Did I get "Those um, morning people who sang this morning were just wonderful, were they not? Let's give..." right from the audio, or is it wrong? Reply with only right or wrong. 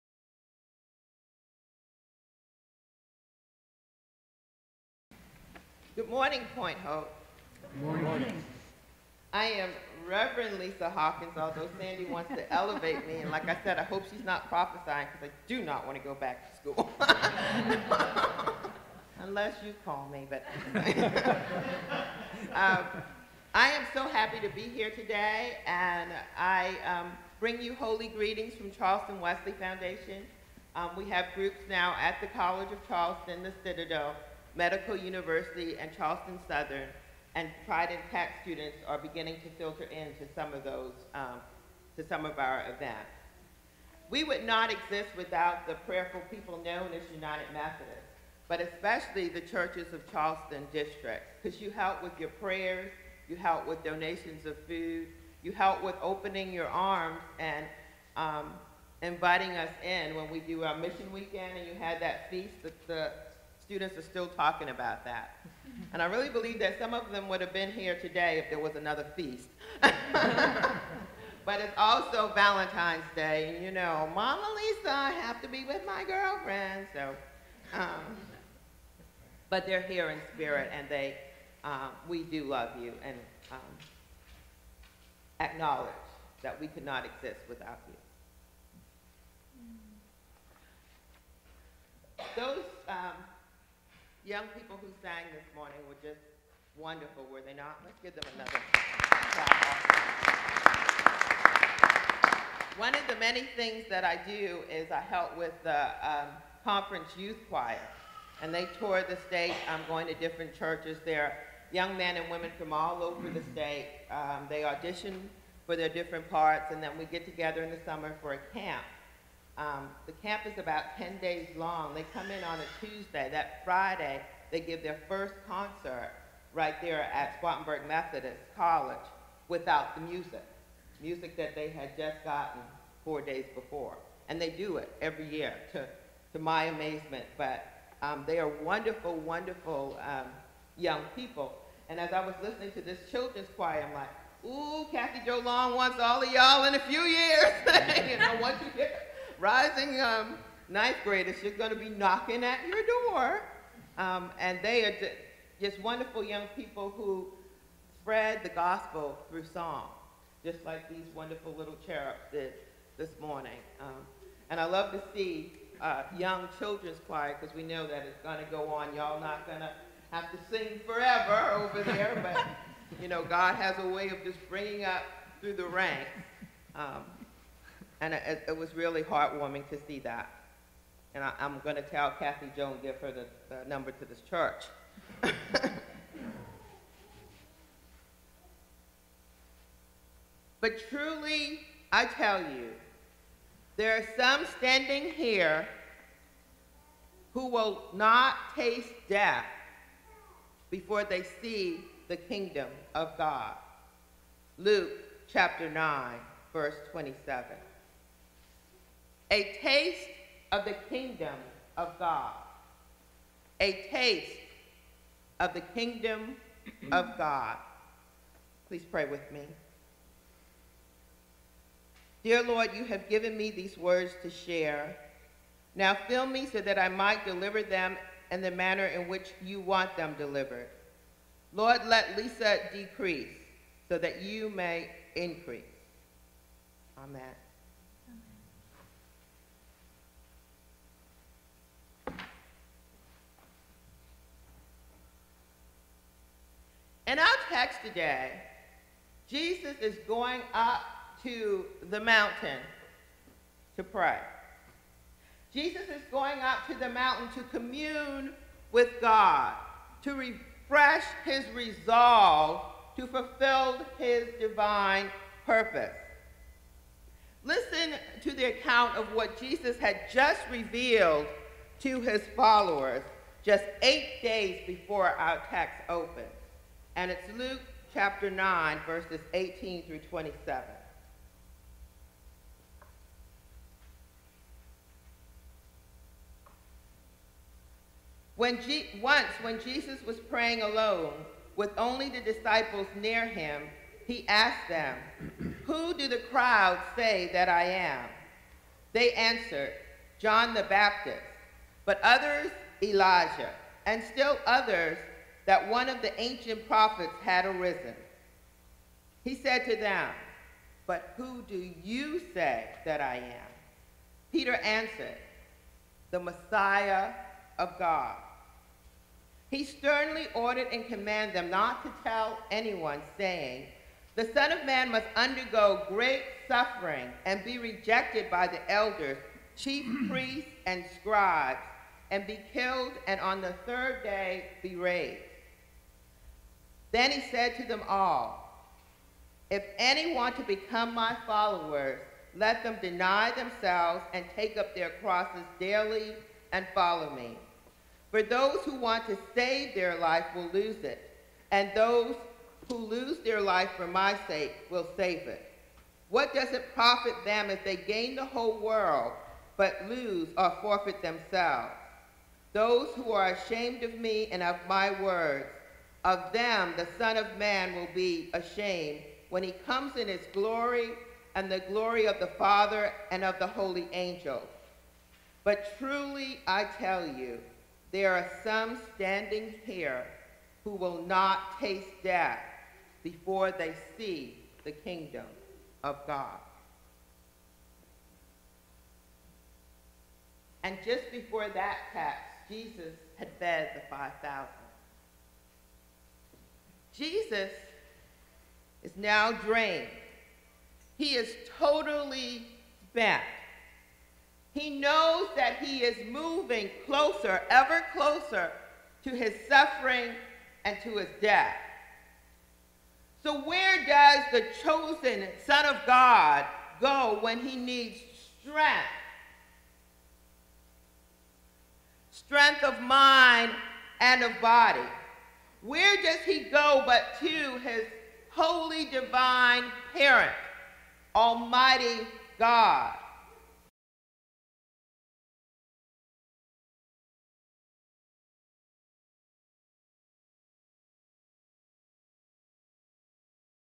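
wrong.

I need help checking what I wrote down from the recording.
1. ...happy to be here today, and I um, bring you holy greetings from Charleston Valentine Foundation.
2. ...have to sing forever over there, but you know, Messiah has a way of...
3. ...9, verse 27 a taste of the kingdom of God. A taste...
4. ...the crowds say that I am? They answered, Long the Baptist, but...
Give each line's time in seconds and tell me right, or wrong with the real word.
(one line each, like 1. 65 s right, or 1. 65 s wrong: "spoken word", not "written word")
1. 24 s wrong: "Wesley", not "Valentine"
2. 170 s wrong: "God", not "Messiah"
3. 205 s right
4. 296 s wrong: "John", not "Long".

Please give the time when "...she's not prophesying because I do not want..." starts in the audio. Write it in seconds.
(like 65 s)
14 s.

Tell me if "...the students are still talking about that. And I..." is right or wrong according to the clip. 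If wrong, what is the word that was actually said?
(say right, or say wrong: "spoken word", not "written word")
right.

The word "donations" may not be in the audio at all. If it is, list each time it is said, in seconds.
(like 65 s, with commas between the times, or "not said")
53 s.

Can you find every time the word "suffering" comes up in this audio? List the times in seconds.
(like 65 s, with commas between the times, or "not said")
326 s, 409 s.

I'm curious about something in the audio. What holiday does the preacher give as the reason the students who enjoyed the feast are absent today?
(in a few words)
Valentine's Day.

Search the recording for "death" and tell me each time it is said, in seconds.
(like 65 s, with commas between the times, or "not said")
199 s, 382 s, 411 s.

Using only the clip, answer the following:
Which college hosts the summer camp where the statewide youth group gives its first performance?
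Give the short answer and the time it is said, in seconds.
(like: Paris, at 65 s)
Spartanburg Methodist College, at 127 s.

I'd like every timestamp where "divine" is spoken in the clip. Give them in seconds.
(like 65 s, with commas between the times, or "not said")
264 s, 428 s.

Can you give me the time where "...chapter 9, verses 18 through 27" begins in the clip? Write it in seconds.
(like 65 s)
277 s.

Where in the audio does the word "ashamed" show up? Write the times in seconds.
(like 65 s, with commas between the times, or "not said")
363 s, 368 s.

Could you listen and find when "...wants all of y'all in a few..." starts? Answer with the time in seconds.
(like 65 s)
145 s.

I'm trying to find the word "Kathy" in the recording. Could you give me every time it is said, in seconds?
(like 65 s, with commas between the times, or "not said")
144 s, 182 s.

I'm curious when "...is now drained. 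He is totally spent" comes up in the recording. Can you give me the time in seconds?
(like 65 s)
398 s.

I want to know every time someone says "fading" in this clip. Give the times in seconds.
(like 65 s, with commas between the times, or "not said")
not said.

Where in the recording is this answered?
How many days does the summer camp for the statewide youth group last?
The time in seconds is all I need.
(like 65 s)
120 s.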